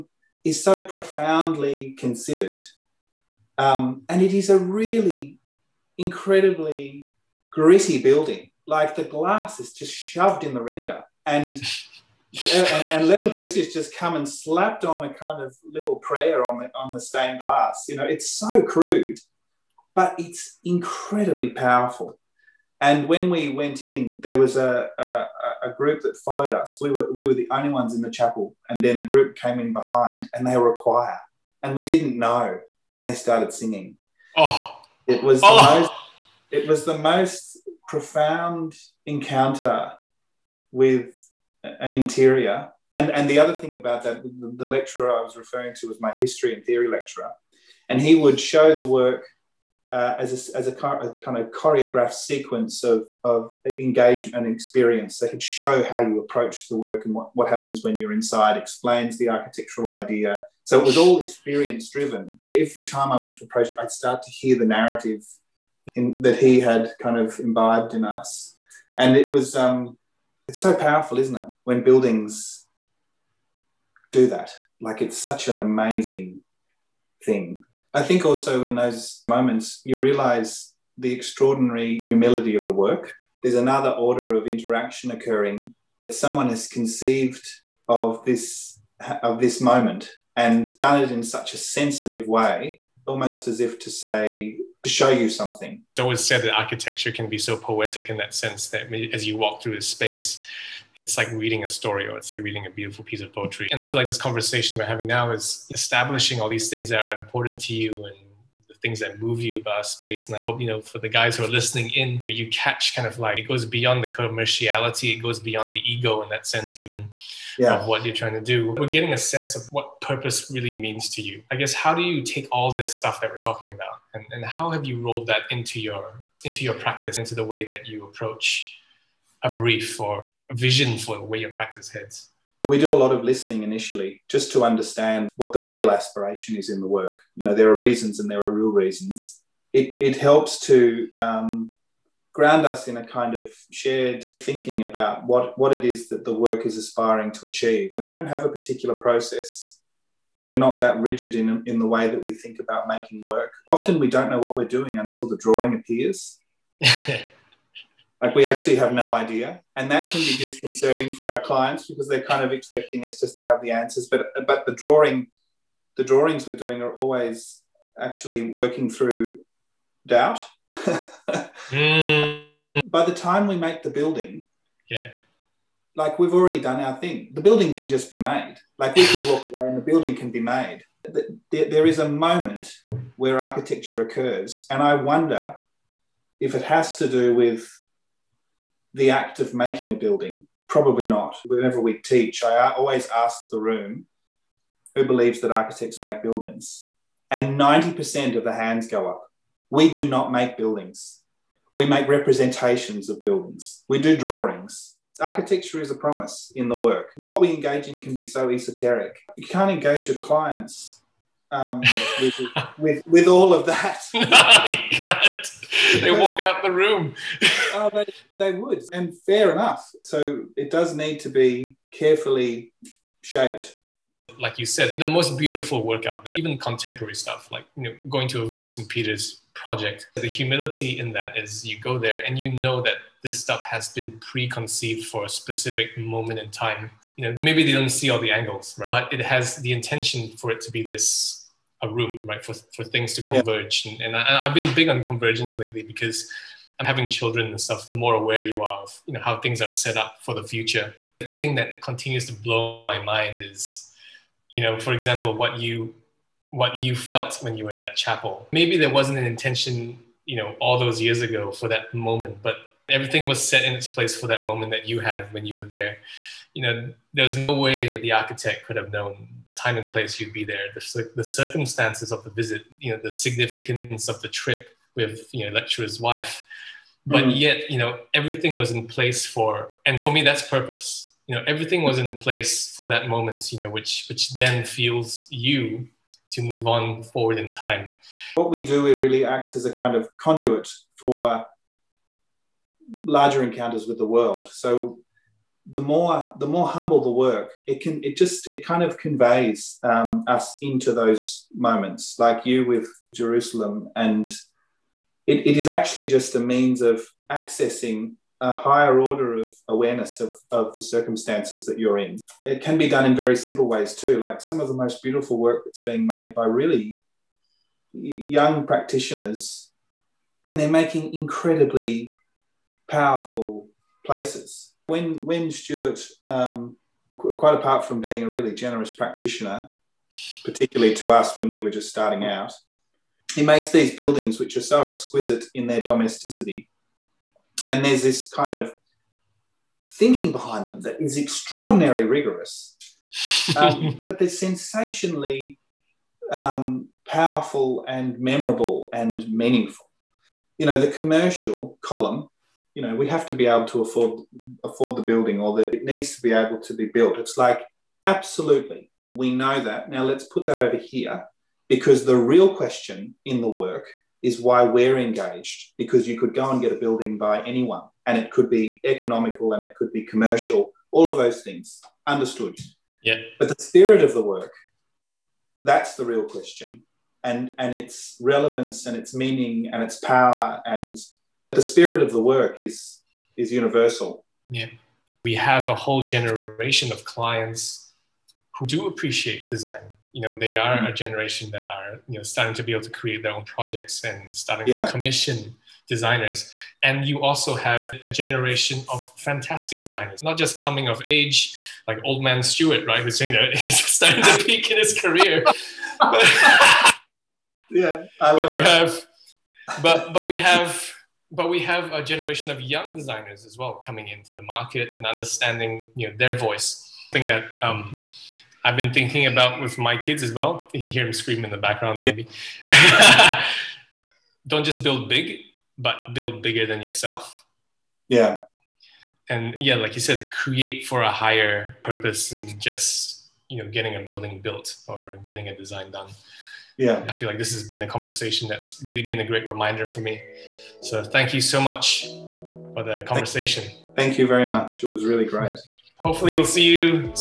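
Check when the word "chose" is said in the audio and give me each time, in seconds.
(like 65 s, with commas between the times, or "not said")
not said.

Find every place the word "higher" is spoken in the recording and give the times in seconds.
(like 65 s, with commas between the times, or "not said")
308 s, 431 s.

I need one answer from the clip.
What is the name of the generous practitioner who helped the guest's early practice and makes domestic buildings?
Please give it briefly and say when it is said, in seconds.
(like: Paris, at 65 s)
Stuart, at 325 s.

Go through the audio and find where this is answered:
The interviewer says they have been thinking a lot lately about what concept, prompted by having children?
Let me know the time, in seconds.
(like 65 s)
245 s.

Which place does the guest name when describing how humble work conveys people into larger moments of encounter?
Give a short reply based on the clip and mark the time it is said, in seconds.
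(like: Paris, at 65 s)
Jerusalem, at 303 s.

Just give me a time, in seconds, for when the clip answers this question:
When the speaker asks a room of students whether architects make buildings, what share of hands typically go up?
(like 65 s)
197 s.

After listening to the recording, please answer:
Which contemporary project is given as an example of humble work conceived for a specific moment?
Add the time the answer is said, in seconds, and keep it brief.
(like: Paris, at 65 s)
St. Peter's, at 228 s.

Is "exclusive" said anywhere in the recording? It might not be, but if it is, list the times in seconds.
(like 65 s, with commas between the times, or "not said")
not said.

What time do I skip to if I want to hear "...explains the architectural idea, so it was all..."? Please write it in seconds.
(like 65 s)
58 s.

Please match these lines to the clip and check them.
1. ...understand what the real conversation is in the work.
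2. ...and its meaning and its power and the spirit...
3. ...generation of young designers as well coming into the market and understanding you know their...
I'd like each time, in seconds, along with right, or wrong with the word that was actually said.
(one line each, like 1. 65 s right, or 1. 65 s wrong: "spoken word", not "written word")
1. 134 s wrong: "aspiration", not "conversation"
2. 378 s right
3. 412 s right.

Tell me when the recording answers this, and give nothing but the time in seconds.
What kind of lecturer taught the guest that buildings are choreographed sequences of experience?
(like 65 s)
46 s.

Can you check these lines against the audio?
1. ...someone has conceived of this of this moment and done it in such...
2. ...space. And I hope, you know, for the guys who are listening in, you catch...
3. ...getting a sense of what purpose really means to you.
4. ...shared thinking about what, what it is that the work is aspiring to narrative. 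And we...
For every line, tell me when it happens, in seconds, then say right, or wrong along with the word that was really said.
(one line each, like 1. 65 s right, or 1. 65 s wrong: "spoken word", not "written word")
1. 86 s right
2. 109 s right
3. 118 s right
4. 143 s wrong: "achieve", not "narrative".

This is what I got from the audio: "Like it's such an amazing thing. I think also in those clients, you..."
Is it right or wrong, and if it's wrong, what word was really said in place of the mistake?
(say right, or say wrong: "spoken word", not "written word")
wrong: "moments", not "clients".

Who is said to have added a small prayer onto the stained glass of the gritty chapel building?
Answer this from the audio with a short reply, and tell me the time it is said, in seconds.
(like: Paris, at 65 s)
Leopold, at 13 s.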